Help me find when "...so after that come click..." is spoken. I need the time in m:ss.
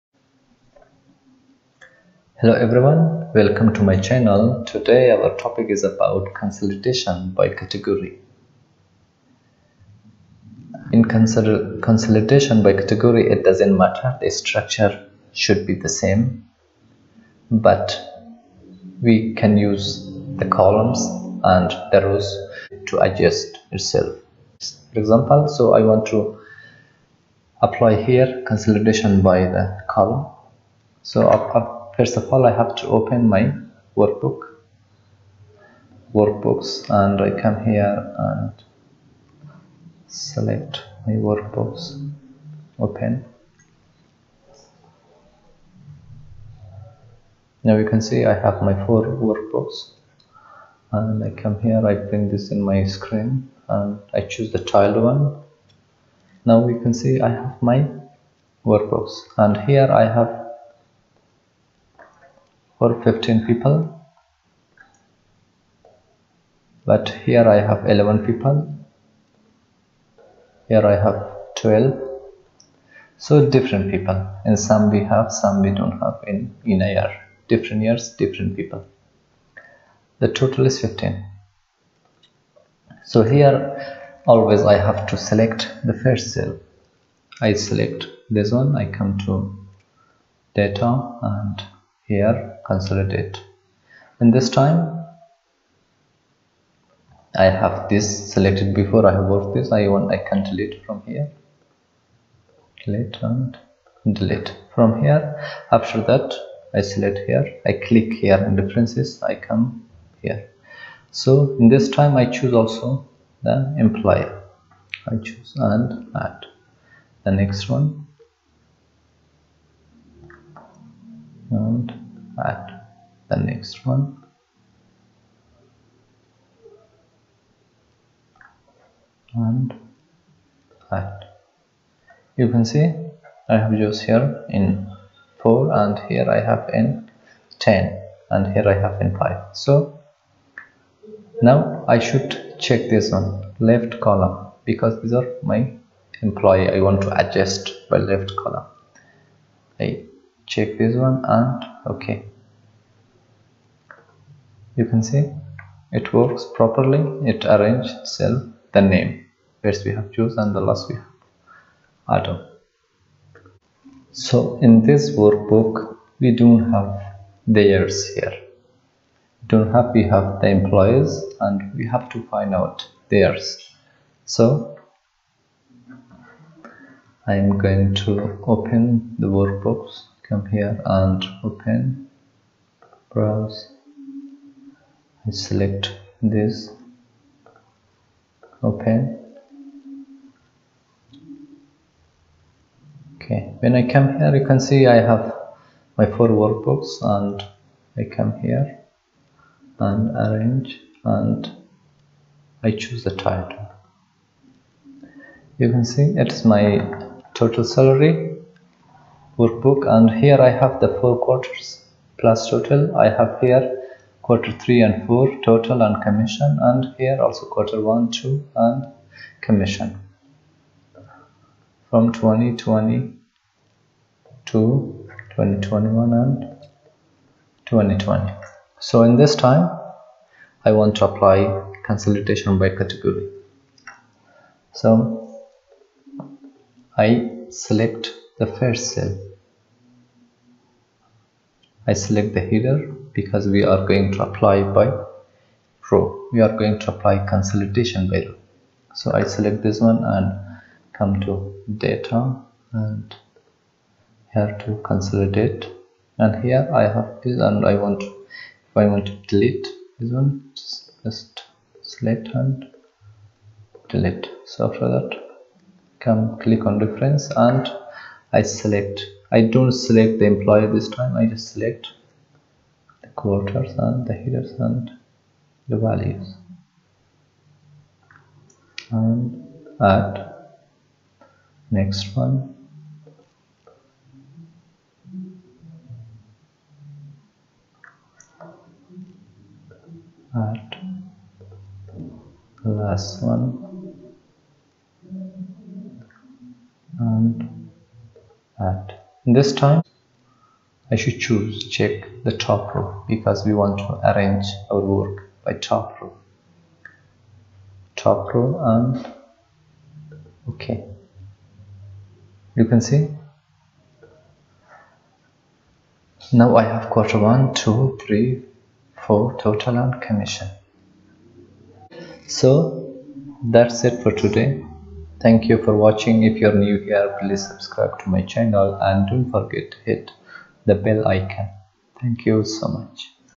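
4:24.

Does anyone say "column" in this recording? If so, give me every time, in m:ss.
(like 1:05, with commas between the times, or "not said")
0:20, 0:29, 2:23, 2:28.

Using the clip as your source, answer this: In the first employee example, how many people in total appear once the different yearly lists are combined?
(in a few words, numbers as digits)
15.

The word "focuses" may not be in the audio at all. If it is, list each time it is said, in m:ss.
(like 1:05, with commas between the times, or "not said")
not said.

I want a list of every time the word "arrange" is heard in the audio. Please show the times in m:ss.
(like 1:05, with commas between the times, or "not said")
2:37, 3:20, 5:04.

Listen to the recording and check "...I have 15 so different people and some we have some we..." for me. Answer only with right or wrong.
wrong.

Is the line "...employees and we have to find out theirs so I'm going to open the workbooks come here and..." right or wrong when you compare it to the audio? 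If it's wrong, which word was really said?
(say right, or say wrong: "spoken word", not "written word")
right.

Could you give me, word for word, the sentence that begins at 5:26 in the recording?
If you're new here, please subscribe to my channel and don't forget to hit the bell icon.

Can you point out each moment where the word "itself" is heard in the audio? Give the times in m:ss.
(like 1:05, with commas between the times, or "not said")
0:23, 2:37.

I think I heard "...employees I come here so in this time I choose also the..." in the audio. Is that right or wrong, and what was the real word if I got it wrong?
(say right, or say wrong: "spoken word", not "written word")
wrong: "differences", not "employees".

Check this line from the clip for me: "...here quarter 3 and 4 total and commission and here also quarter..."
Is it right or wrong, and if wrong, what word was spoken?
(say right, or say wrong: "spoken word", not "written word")
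right.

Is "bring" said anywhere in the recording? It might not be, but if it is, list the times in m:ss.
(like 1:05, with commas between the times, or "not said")
0:51.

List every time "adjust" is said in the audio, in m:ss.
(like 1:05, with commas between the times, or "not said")
0:23, 2:27.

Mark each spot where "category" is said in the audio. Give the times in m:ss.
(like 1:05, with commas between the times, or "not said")
0:07, 0:12, 3:52.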